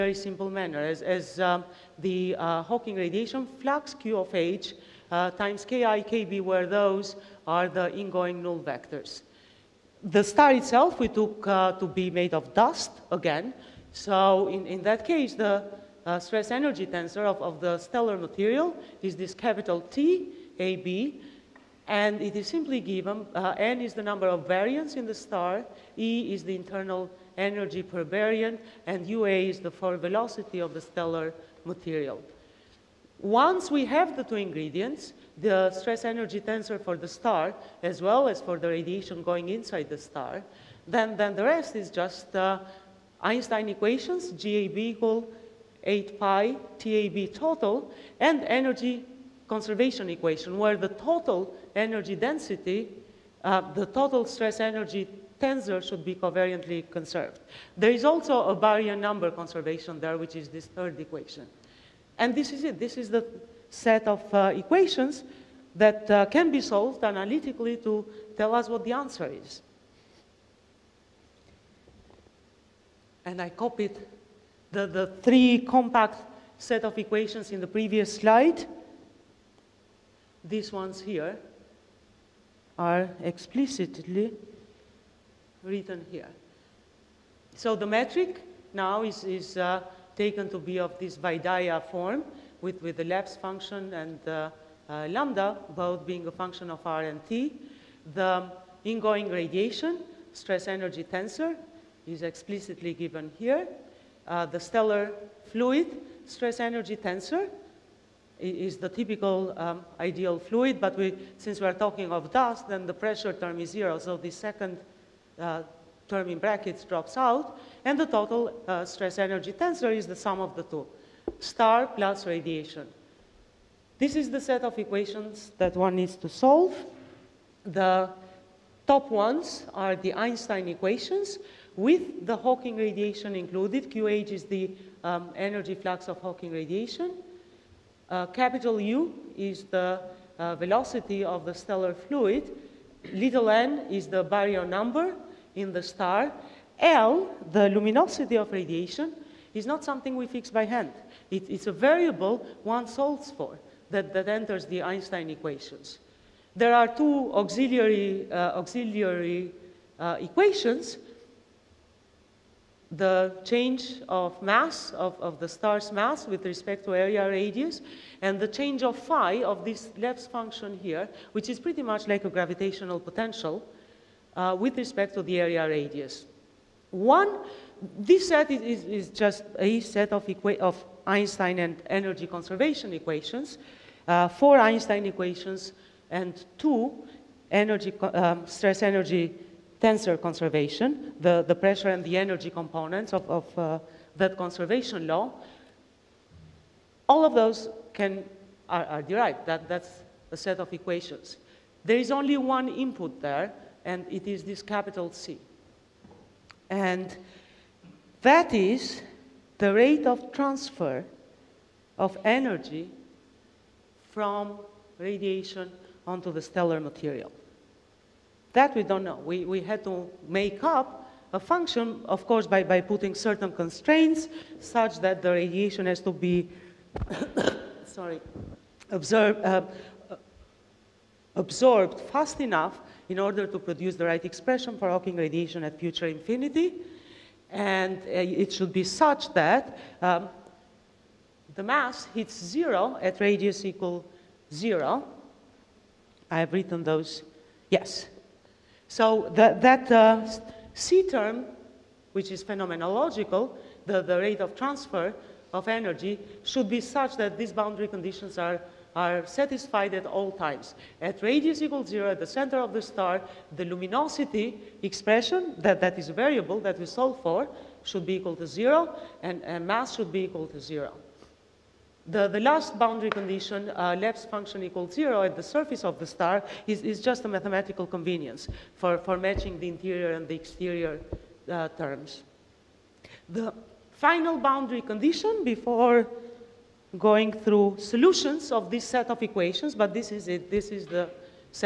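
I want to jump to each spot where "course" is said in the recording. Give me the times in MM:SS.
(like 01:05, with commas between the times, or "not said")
03:42.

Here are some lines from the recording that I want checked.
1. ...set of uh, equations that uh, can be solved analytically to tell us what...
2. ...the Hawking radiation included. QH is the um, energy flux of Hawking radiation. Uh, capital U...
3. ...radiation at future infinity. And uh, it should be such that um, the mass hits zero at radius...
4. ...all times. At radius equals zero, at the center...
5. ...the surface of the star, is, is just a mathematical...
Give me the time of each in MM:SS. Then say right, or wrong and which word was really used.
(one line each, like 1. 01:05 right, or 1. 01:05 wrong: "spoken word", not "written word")
1. 01:03 right
2. 02:12 right
3. 03:55 right
4. 04:20 right
5. 04:35 right.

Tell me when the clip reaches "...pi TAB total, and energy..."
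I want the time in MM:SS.
00:46.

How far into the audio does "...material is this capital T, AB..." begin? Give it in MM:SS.
00:18.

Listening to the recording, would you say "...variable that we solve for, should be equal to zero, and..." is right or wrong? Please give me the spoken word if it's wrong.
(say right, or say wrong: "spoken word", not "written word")
right.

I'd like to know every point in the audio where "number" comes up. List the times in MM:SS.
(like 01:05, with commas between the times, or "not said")
00:24, 00:58, 02:24.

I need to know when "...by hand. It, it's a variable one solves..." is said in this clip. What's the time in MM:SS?
02:30.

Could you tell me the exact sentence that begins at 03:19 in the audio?
That, that's a set of equations.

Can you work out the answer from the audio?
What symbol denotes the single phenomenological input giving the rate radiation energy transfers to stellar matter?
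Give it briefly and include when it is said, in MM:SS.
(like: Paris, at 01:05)
Capital C, at 03:24.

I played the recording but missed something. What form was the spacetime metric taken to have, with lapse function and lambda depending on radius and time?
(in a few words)
Vaidya form.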